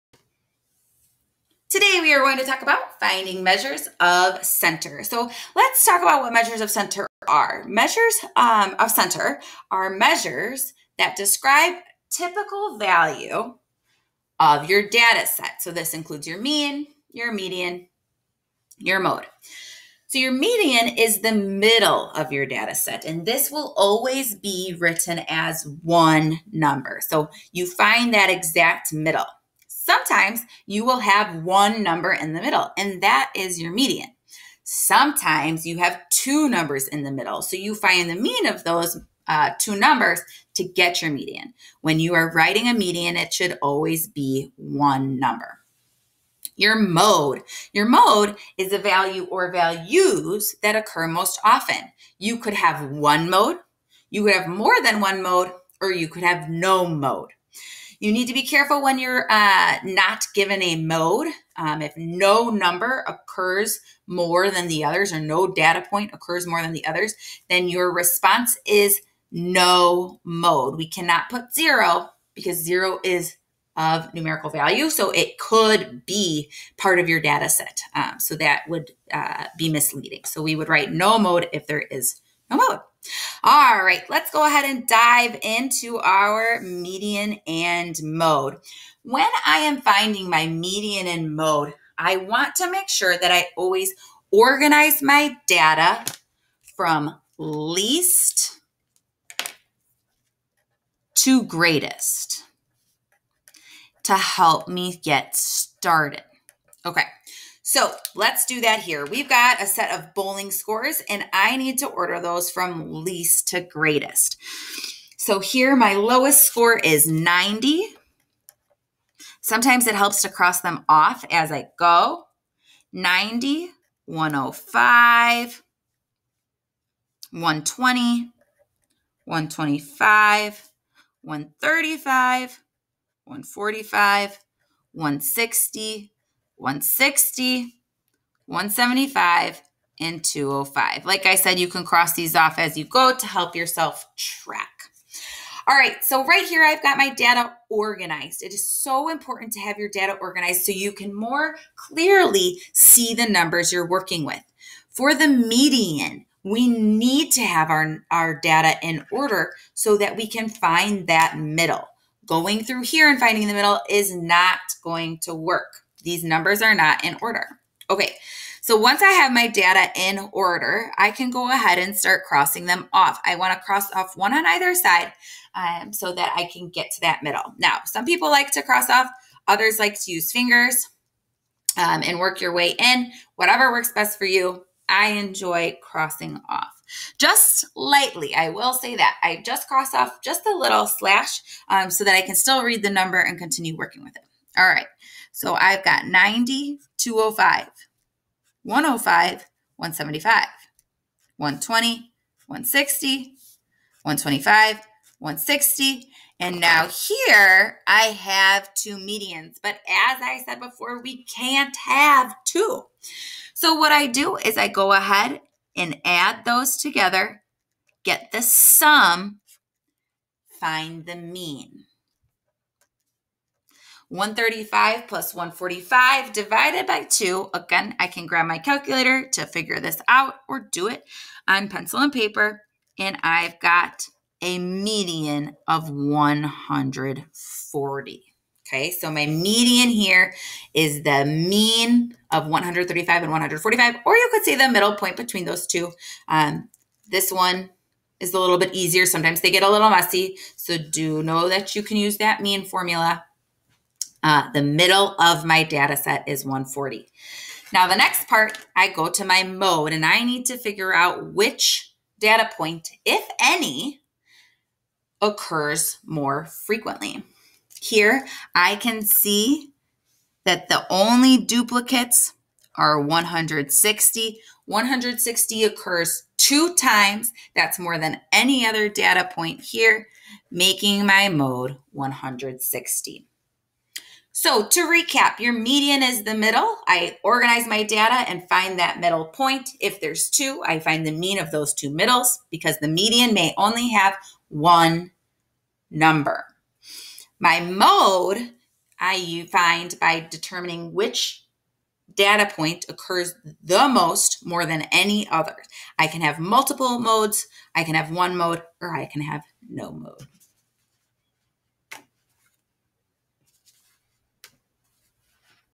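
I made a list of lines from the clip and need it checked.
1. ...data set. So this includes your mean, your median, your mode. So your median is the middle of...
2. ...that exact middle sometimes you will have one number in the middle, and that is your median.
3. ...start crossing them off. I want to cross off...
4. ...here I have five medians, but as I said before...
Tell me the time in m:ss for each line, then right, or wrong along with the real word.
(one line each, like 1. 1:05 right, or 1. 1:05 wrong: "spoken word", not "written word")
1. 0:14 right
2. 0:28 right
3. 2:51 right
4. 3:26 wrong: "two", not "five".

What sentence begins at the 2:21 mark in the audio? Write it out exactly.
Like I said, you can cross these off as you go to help yourself track.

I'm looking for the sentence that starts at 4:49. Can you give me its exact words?
If there's two, I find the mean of those two middles because the median may only have one number.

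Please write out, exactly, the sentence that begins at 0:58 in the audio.
You need to be careful when you're uh, not given a mode.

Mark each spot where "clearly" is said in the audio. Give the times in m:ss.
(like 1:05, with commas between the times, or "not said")
2:31.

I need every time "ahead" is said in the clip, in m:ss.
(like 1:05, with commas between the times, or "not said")
1:24, 2:51, 3:34.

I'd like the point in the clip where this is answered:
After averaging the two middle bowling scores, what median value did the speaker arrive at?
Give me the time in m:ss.
3:53.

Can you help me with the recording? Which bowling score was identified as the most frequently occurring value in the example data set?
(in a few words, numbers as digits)
160.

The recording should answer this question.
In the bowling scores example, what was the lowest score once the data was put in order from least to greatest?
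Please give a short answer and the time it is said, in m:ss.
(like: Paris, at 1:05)
90, at 1:55.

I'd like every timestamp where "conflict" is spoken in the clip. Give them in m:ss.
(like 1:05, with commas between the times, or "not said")
not said.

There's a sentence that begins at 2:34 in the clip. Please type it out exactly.
For the median, we need to have our, our data in order so that we can find that middle.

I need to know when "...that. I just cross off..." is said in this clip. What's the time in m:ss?
3:08.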